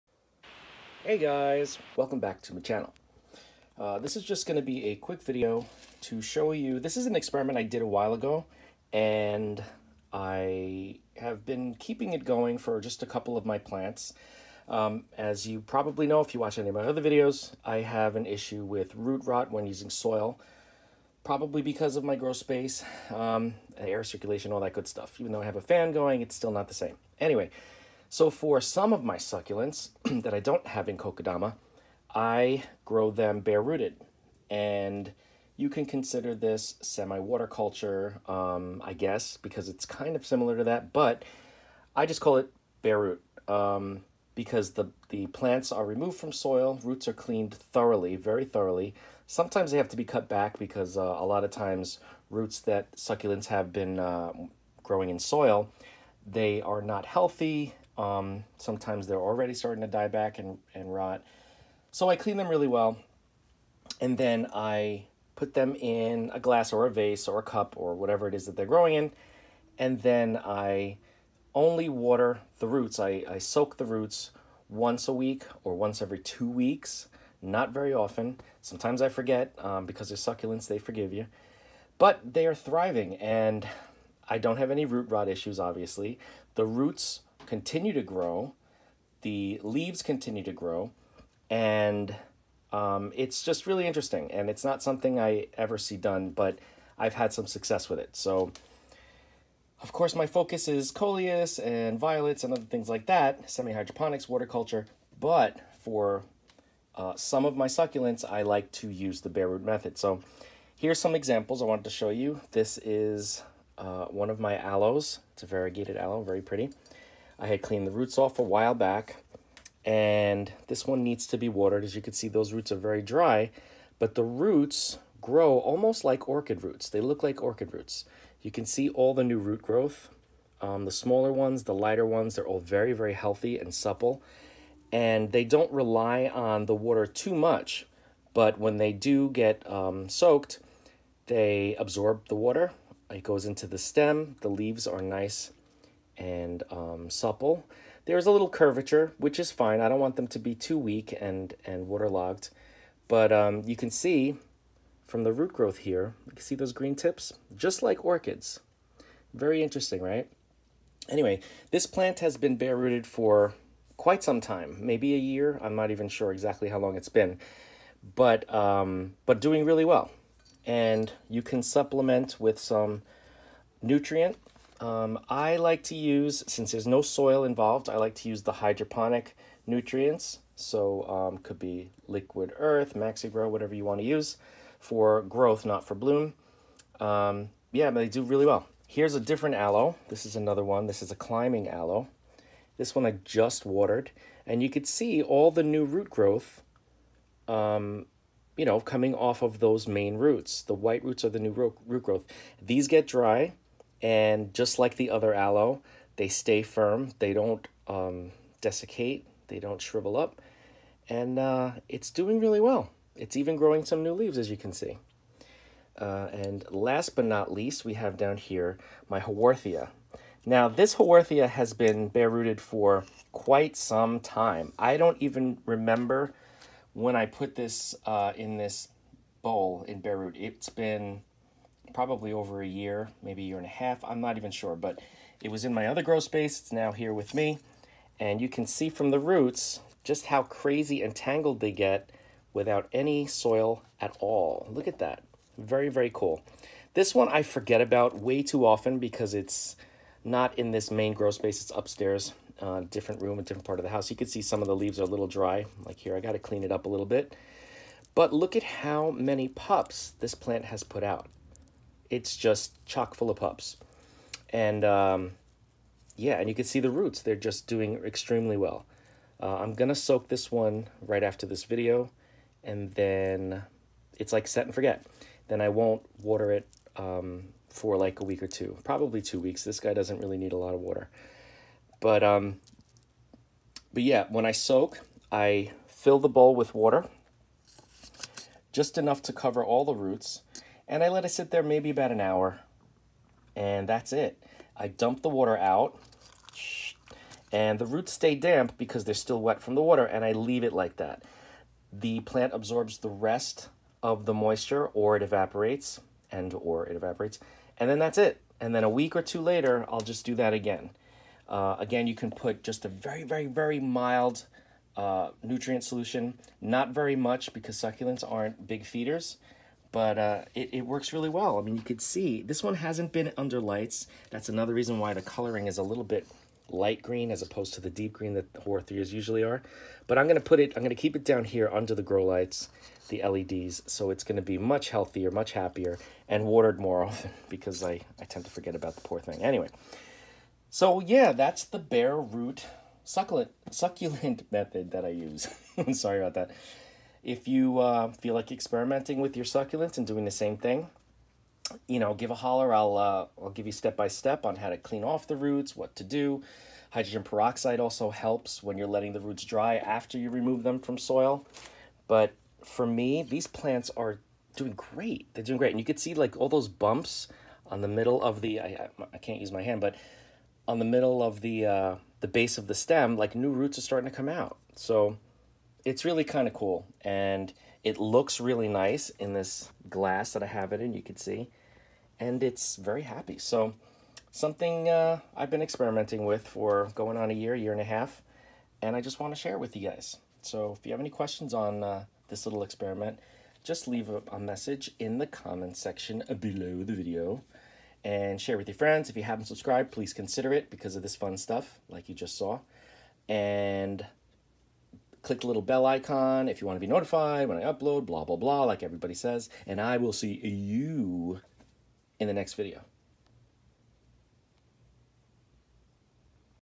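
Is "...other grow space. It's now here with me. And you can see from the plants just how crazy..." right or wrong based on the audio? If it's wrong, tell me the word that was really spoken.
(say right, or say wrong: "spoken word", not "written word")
wrong: "roots", not "plants".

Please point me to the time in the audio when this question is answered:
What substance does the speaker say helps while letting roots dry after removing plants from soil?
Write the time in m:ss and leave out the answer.
5:56.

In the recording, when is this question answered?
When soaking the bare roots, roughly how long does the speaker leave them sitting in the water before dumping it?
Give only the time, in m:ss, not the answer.
4:51.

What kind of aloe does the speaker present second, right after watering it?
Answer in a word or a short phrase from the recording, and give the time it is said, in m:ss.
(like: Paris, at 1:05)
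Climbing aloe, at 3:11.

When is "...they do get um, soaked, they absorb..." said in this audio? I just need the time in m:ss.
2:18.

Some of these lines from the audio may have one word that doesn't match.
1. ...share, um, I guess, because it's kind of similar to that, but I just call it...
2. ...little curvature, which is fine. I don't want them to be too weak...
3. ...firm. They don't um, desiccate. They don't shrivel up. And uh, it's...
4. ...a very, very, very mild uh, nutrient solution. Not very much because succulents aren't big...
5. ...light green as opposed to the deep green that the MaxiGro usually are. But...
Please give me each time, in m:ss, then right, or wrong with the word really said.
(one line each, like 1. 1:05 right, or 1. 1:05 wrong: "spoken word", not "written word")
1. 0:37 wrong: "culture", not "share"
2. 2:28 right
3. 3:26 right
4. 5:12 right
5. 5:26 wrong: "Haworthias", not "MaxiGro".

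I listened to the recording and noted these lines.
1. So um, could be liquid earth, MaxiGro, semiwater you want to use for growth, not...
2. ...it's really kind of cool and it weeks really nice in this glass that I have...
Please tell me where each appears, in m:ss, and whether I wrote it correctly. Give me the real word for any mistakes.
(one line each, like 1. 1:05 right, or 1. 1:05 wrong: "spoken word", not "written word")
1. 3:00 wrong: "whatever", not "semiwater"
2. 6:15 wrong: "looks", not "weeks".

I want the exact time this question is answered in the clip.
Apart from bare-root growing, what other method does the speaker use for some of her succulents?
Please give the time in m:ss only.
0:30.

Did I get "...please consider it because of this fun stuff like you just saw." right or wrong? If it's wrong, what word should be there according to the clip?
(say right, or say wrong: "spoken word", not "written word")
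right.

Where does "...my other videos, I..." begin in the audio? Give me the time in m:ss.
0:16.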